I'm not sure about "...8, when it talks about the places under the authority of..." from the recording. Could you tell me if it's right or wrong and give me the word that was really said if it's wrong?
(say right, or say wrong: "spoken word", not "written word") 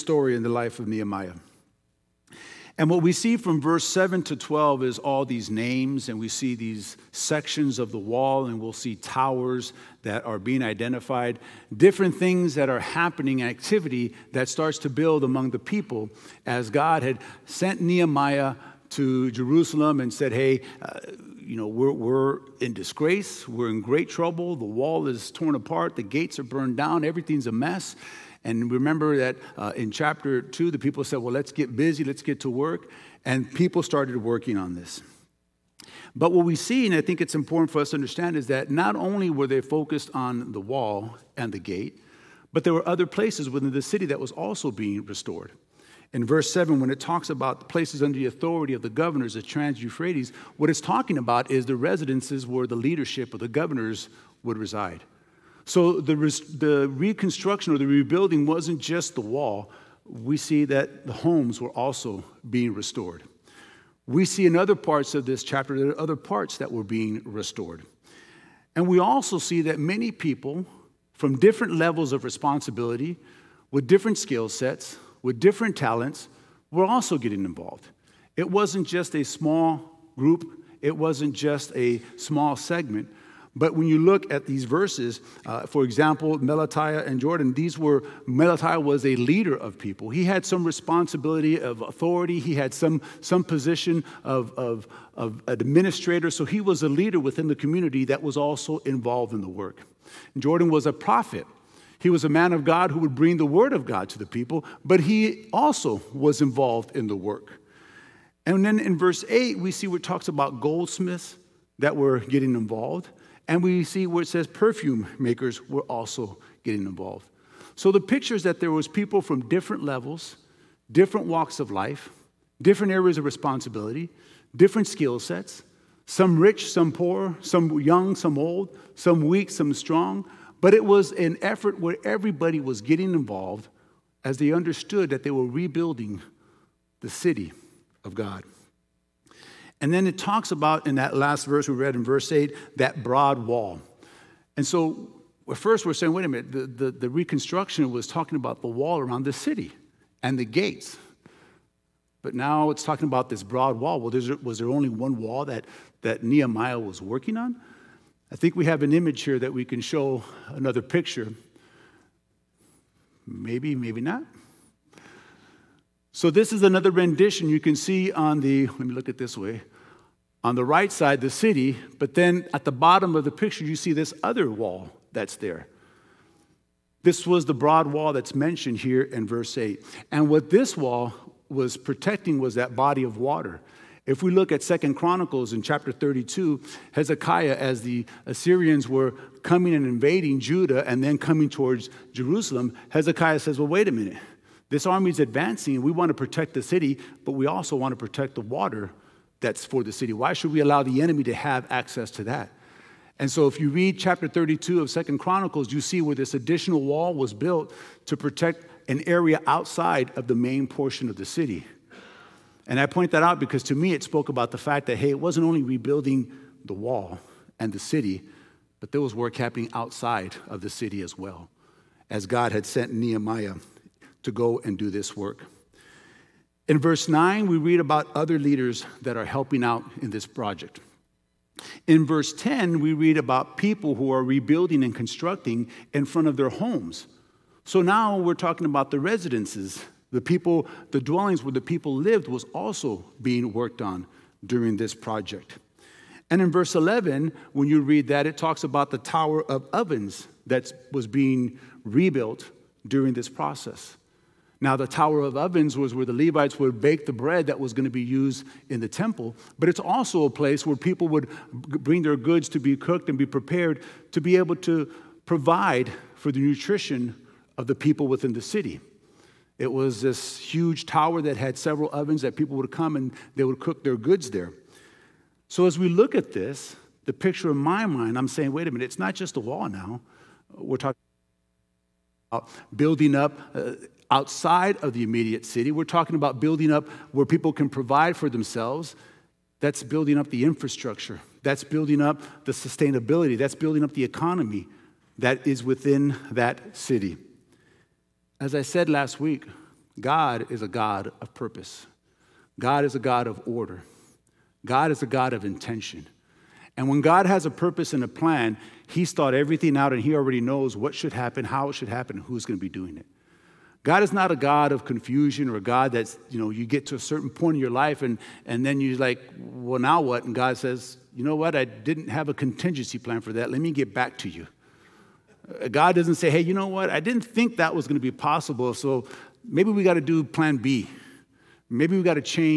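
wrong: "7", not "8".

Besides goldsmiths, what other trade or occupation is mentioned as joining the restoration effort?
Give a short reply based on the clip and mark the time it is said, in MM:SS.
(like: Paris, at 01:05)
Perfume makers, at 01:54.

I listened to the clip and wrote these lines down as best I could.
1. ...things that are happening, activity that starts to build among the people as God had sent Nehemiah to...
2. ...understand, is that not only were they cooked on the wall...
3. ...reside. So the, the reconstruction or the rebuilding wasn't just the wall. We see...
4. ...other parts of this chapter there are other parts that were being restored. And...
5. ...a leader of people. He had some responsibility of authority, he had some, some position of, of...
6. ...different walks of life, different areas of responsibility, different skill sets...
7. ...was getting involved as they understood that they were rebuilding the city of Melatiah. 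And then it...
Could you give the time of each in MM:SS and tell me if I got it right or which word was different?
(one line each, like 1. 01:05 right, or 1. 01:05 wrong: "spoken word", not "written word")
1. 00:12 right
2. 00:37 wrong: "focused", not "cooked"
3. 00:54 right
4. 01:04 right
5. 01:29 right
6. 02:00 right
7. 02:12 wrong: "God", not "Melatiah".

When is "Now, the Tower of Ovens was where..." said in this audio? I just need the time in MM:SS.
04:14.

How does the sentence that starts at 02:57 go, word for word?
This was the broad wall that's mentioned here in verse 8.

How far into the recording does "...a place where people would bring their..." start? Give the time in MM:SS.
04:20.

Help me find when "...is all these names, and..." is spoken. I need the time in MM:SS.
00:04.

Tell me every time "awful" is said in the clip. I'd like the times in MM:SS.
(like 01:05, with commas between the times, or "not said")
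not said.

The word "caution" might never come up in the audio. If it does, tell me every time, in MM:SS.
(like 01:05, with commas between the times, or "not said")
not said.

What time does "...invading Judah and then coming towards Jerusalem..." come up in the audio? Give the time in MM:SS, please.
03:09.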